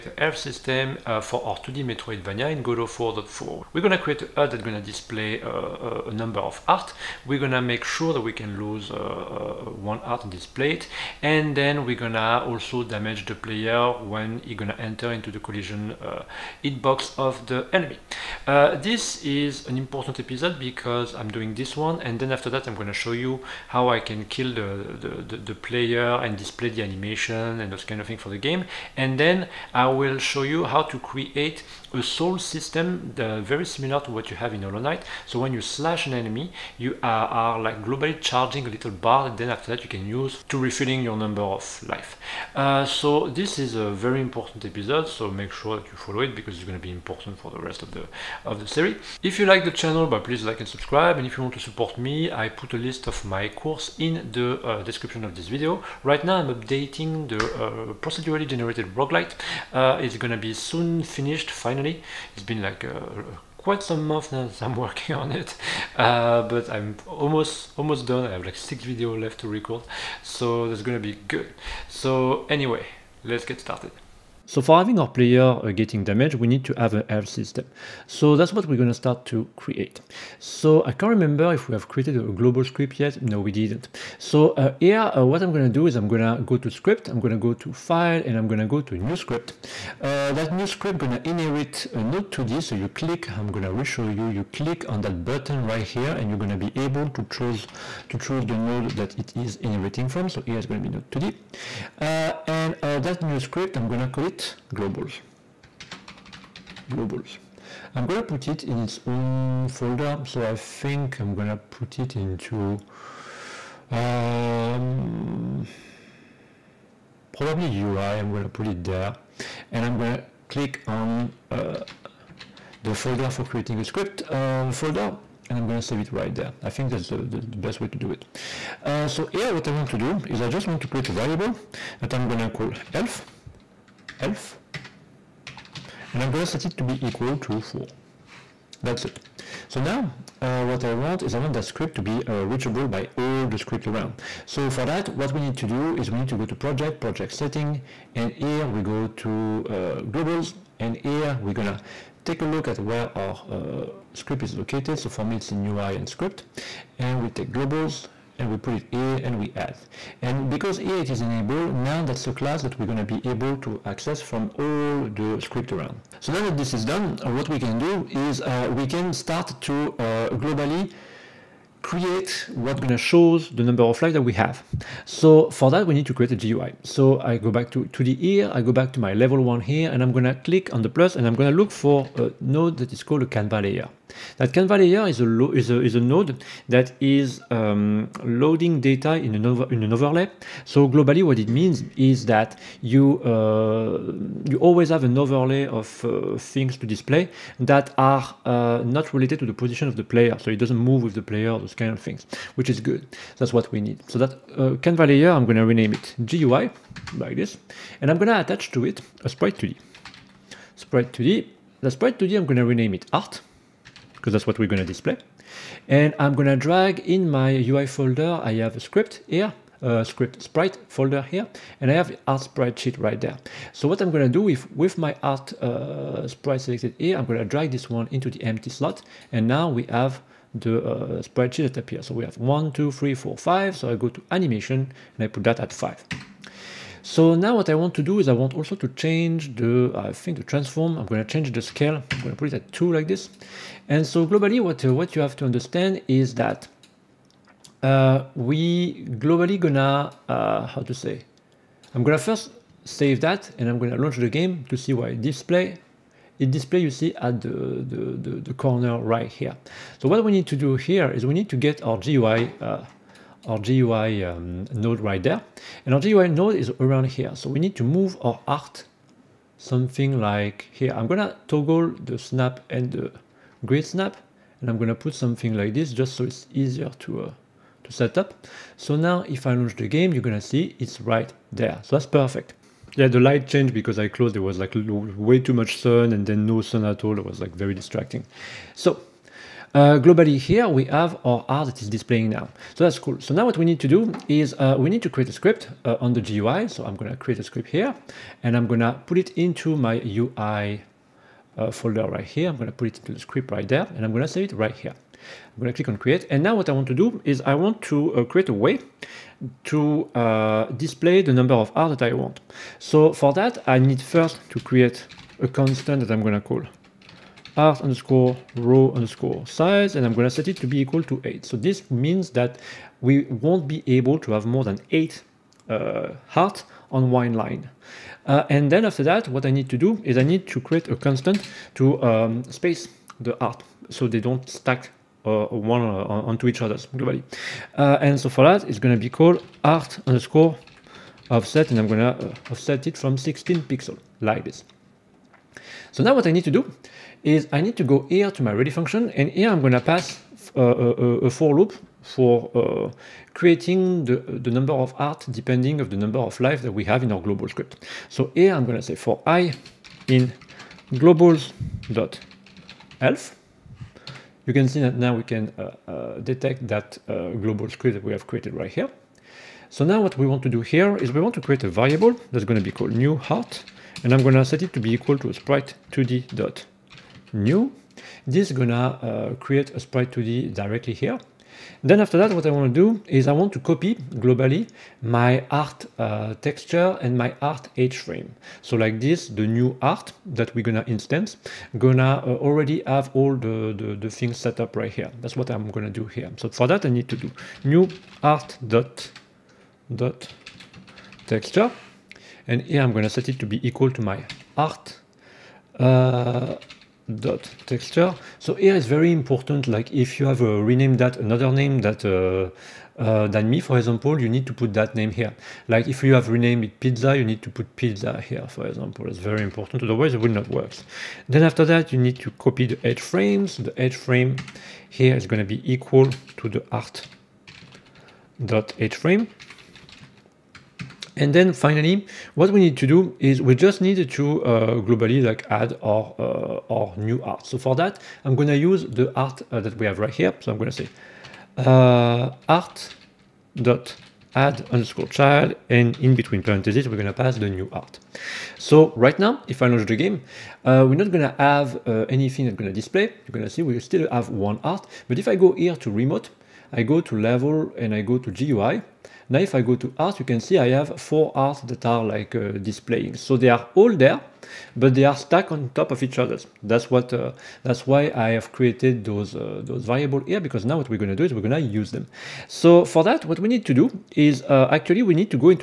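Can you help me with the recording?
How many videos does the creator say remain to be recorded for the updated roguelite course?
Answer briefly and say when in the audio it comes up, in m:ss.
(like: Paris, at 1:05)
6, at 1:08.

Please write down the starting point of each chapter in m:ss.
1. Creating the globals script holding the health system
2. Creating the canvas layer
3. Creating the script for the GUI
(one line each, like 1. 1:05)
1. 1:13
2. 2:58
3. 4:53.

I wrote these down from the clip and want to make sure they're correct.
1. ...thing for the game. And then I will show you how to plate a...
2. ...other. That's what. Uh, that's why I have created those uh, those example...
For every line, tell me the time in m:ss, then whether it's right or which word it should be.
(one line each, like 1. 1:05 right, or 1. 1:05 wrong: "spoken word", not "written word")
1. 0:28 wrong: "create", not "plate"
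2. 7:46 wrong: "variable", not "example".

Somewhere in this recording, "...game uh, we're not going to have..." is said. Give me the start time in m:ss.
7:29.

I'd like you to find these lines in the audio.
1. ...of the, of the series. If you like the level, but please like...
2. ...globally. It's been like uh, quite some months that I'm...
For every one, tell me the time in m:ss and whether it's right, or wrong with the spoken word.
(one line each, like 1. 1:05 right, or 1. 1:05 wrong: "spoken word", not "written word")
1. 0:47 wrong: "channel", not "level"
2. 1:01 wrong: "finally", not "globally".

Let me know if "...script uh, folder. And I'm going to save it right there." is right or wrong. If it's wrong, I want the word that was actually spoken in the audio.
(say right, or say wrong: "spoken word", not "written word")
right.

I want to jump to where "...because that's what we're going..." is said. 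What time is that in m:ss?
3:34.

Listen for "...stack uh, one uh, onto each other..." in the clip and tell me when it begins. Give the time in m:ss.
5:34.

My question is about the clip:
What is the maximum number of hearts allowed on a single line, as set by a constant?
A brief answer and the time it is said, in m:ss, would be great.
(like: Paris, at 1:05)
8, at 5:20.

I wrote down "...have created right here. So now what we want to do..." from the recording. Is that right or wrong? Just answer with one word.
right.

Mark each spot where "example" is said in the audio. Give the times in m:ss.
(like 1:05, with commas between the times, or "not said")
6:53, 6:58.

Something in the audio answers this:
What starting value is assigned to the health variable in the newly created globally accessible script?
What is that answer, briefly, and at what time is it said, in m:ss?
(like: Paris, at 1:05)
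4, at 2:16.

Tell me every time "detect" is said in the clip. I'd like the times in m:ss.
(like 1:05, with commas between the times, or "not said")
6:06.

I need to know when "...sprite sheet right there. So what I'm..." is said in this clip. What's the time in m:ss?
3:42.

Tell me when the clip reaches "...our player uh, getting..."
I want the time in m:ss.
1:14.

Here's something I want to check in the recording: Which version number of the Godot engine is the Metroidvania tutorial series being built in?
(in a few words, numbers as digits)
4.4.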